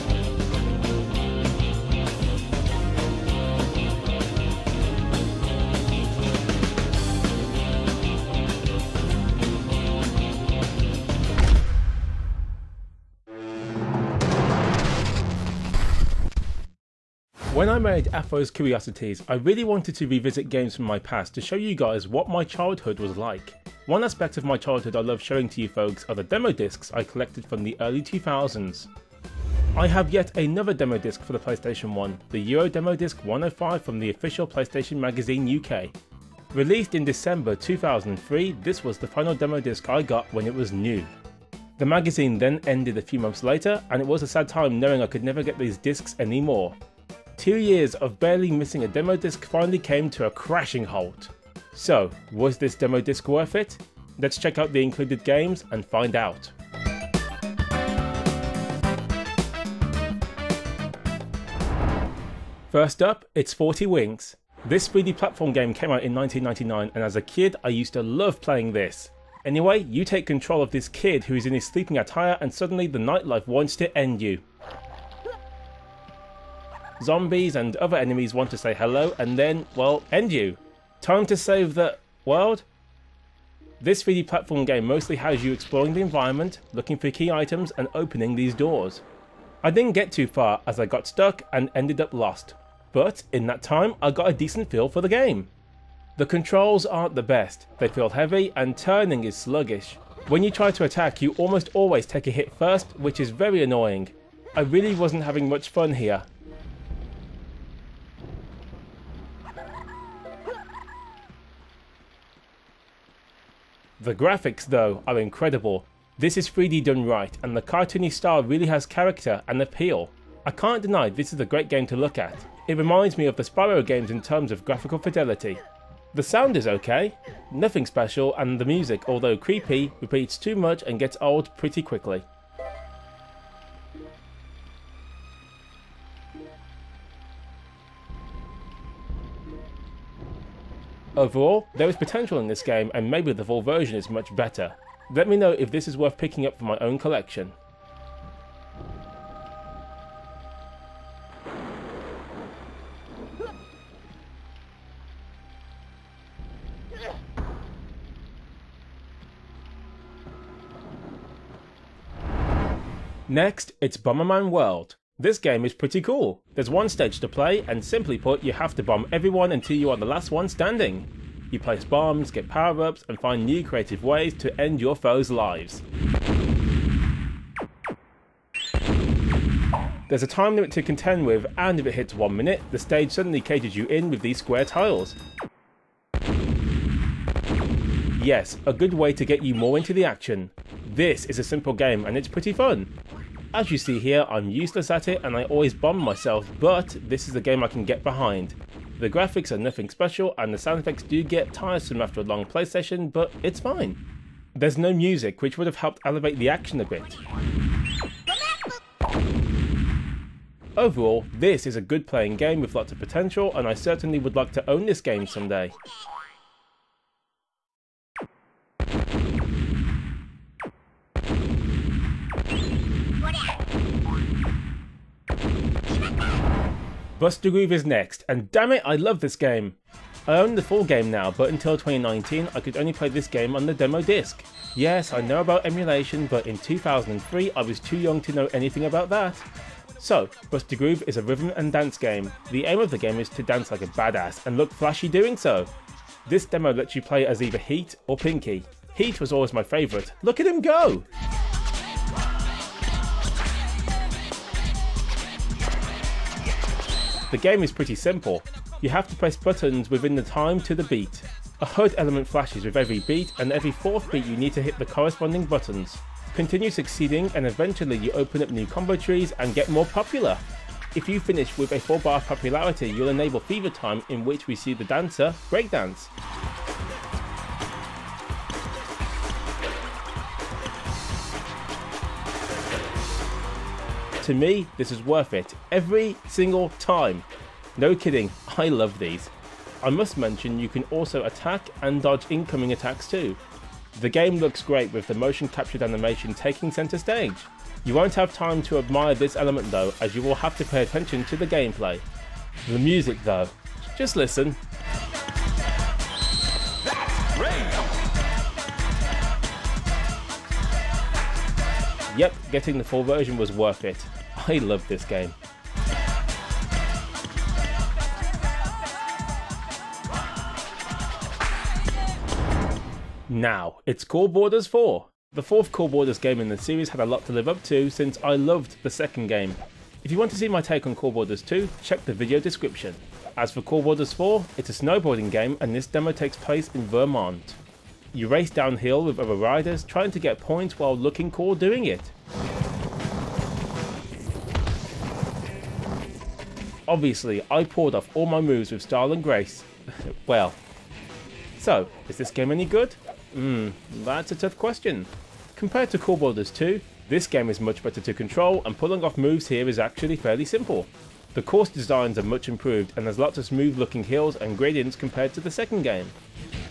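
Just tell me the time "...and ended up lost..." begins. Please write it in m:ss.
1:31.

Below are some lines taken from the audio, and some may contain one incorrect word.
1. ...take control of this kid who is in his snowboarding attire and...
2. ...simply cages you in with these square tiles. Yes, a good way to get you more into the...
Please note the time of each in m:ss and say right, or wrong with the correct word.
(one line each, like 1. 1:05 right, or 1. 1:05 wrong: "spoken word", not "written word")
1. 1:10 wrong: "sleeping", not "snowboarding"
2. 3:03 wrong: "suddenly", not "simply".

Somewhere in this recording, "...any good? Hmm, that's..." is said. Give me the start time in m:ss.
5:52.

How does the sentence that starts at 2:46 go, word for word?
There's one stage to play, and simply put, you have to bomb everyone until you are the last one standing.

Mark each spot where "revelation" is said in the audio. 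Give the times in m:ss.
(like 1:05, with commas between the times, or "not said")
not said.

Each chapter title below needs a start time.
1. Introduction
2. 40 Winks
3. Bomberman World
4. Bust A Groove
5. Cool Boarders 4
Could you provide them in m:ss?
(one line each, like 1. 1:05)
1. 0:16
2. 1:01
3. 2:41
4. 3:46
5. 5:21.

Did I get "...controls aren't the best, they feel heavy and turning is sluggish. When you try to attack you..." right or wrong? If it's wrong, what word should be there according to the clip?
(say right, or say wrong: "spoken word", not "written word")
right.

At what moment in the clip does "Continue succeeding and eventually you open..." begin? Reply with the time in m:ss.
4:26.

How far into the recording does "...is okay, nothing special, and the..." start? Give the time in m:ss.
2:06.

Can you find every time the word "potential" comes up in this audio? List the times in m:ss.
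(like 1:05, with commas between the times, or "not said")
2:21, 3:32.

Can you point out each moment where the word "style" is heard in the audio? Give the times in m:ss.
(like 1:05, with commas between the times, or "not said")
1:58, 5:48.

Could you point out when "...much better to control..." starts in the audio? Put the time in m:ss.
5:57.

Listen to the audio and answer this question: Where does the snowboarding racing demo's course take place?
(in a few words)
Vermont.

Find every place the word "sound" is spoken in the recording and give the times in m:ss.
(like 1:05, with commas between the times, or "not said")
2:06, 3:20.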